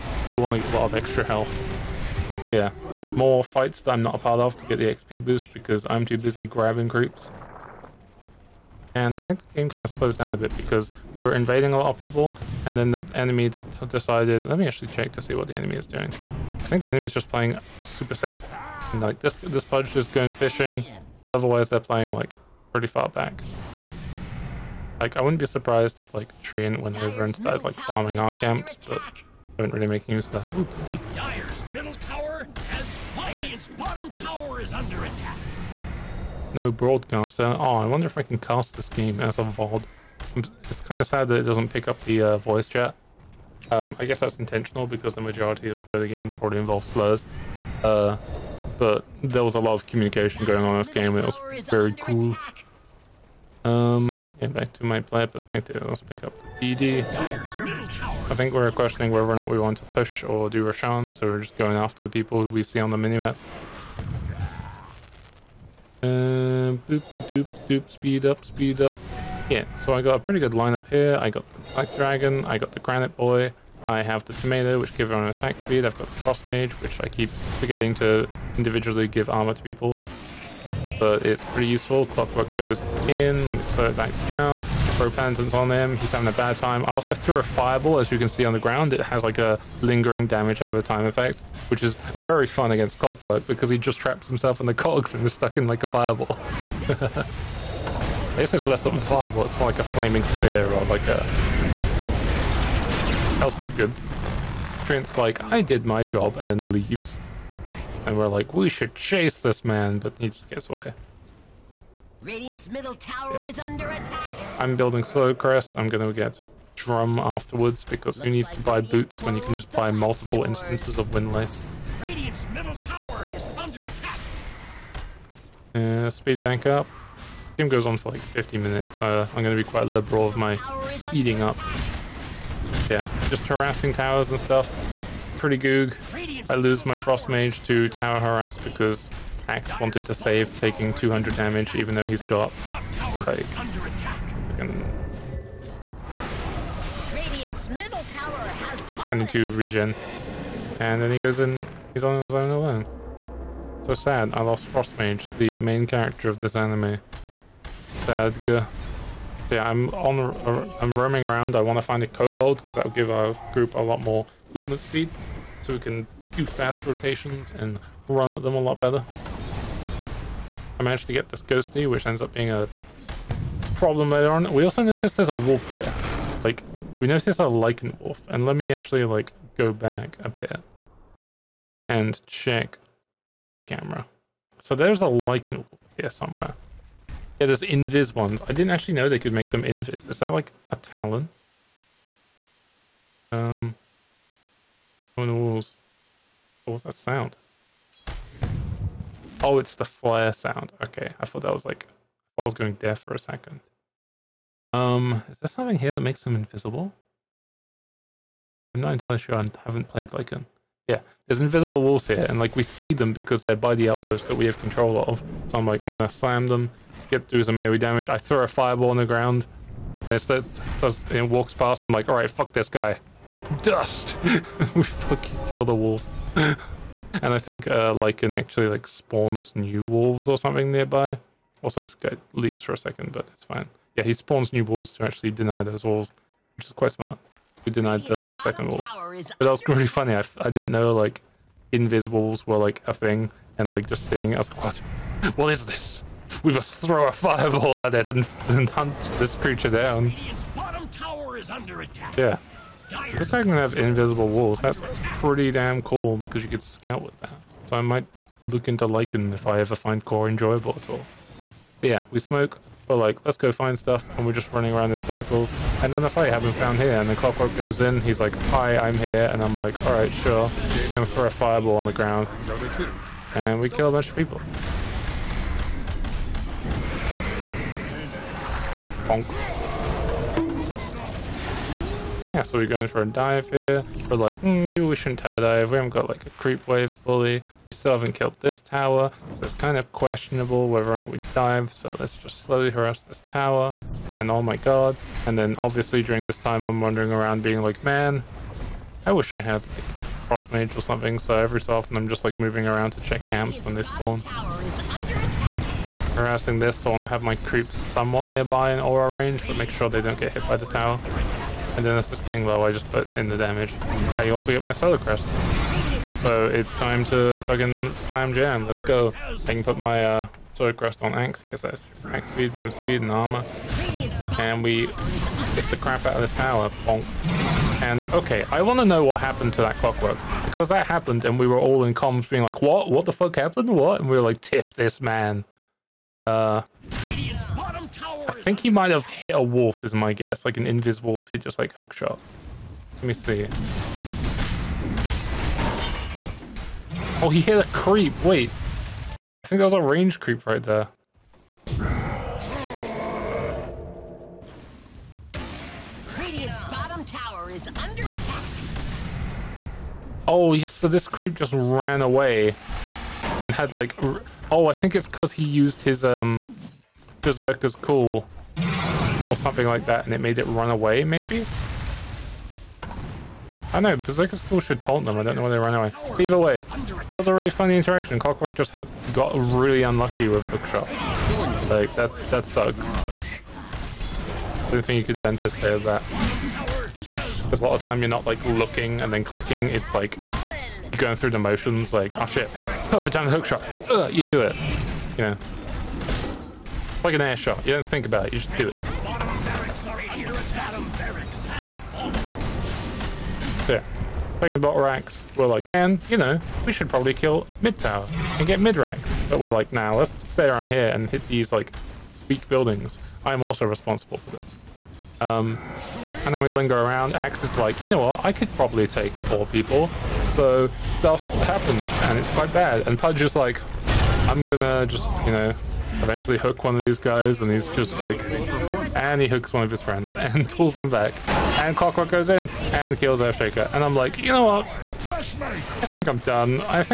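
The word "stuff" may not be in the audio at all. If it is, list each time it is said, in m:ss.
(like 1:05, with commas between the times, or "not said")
2:14, 4:23, 7:00.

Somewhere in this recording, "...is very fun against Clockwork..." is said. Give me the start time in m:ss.
1:31.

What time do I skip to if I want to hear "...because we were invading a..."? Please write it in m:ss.
0:10.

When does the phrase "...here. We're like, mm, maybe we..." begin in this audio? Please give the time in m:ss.
4:43.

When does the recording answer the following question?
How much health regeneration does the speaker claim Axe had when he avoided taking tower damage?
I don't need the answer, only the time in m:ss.
2:28.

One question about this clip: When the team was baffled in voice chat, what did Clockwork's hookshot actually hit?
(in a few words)
A range creep.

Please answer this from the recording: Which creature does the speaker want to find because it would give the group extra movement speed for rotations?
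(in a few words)
kobold.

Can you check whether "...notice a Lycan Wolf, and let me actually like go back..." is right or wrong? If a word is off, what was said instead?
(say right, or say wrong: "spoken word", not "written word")
right.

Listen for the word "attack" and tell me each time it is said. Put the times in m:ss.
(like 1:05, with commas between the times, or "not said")
0:35, 1:15, 1:53, 2:03, 5:58.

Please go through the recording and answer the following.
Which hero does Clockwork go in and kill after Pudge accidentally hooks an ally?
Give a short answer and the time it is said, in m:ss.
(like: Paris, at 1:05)
Earthshaker, at 7:13.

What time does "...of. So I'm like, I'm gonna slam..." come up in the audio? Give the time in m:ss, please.
3:35.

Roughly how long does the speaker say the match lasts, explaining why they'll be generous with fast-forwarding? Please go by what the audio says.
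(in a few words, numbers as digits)
50 minutes.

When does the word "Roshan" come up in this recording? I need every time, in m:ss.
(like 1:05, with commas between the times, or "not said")
1:00.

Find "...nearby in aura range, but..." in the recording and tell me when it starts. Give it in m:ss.
5:08.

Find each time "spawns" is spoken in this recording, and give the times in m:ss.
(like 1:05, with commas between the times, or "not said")
3:48, 3:54, 5:03.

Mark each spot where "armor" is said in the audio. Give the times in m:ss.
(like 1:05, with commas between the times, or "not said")
1:19, 5:23.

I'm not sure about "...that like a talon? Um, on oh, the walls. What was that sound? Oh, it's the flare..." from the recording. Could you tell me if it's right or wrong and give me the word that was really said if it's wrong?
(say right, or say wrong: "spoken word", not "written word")
right.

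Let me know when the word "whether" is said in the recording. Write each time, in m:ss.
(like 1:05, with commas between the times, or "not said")
0:59, 4:50.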